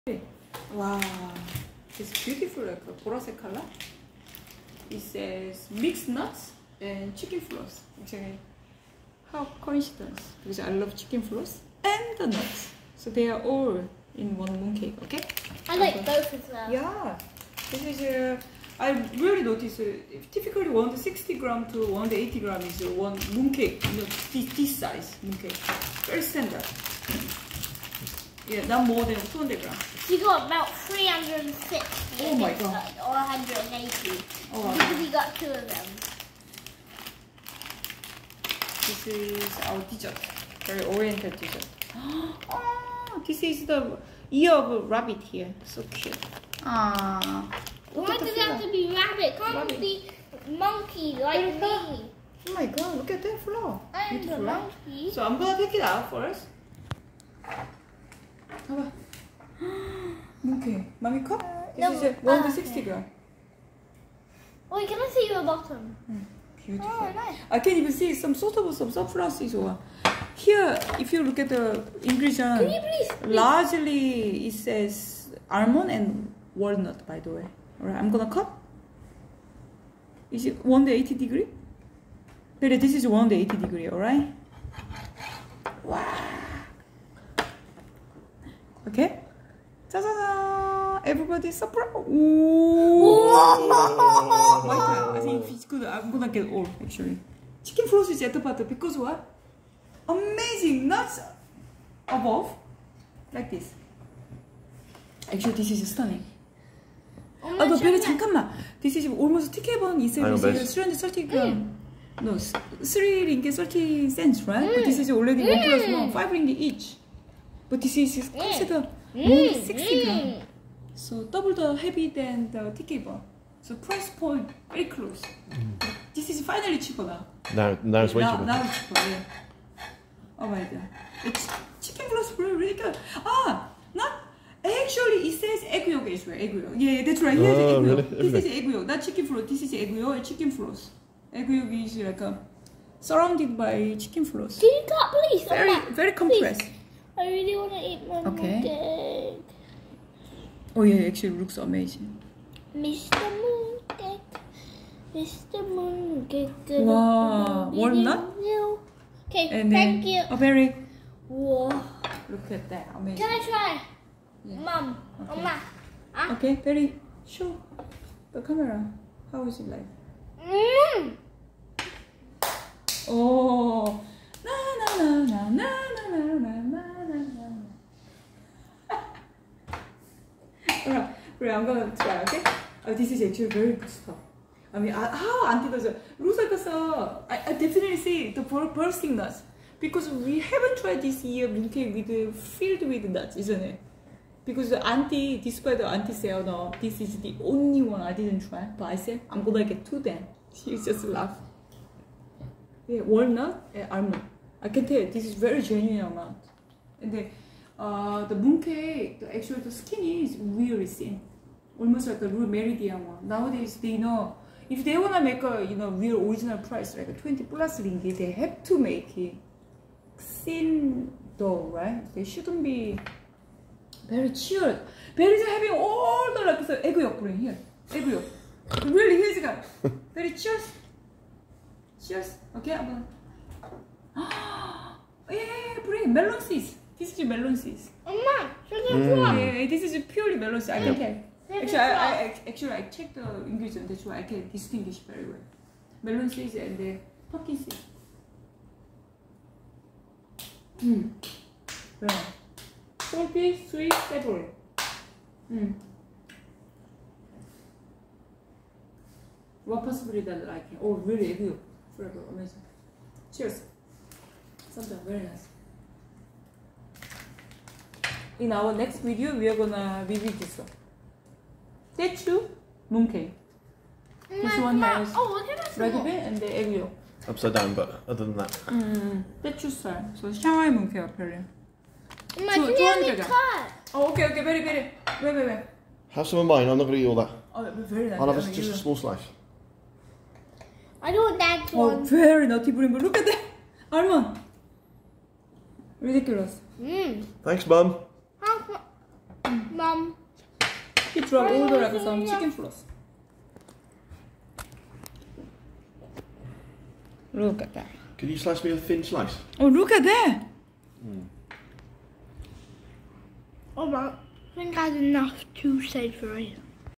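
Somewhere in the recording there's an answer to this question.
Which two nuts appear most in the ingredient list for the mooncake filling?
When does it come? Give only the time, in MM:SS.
01:15.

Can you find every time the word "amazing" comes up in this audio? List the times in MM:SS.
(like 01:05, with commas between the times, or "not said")
01:40, 02:31, 02:42, 04:22.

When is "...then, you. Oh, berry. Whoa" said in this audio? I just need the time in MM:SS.
02:40.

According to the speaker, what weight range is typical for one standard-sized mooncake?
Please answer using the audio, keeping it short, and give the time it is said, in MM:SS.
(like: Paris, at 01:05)
160 to 180 grams, at 00:20.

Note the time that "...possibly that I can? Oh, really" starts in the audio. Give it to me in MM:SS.
04:19.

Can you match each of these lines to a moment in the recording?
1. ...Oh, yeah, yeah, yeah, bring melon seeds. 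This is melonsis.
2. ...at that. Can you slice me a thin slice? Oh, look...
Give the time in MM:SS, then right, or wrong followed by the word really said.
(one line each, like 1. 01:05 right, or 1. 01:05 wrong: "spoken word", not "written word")
1. 03:54 right
2. 05:07 right.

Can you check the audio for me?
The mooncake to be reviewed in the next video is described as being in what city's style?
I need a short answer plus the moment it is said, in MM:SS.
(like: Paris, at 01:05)
Shanghai, at 04:40.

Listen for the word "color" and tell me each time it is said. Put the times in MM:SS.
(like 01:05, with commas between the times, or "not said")
00:03.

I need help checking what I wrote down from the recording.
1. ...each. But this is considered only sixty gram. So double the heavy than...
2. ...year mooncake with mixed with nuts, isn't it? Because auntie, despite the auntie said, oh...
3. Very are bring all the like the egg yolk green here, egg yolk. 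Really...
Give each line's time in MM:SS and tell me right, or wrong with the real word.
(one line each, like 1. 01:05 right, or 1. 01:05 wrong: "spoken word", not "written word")
1. 01:56 right
2. 03:11 wrong: "filled", not "mixed"
3. 03:45 wrong: "having", not "bring".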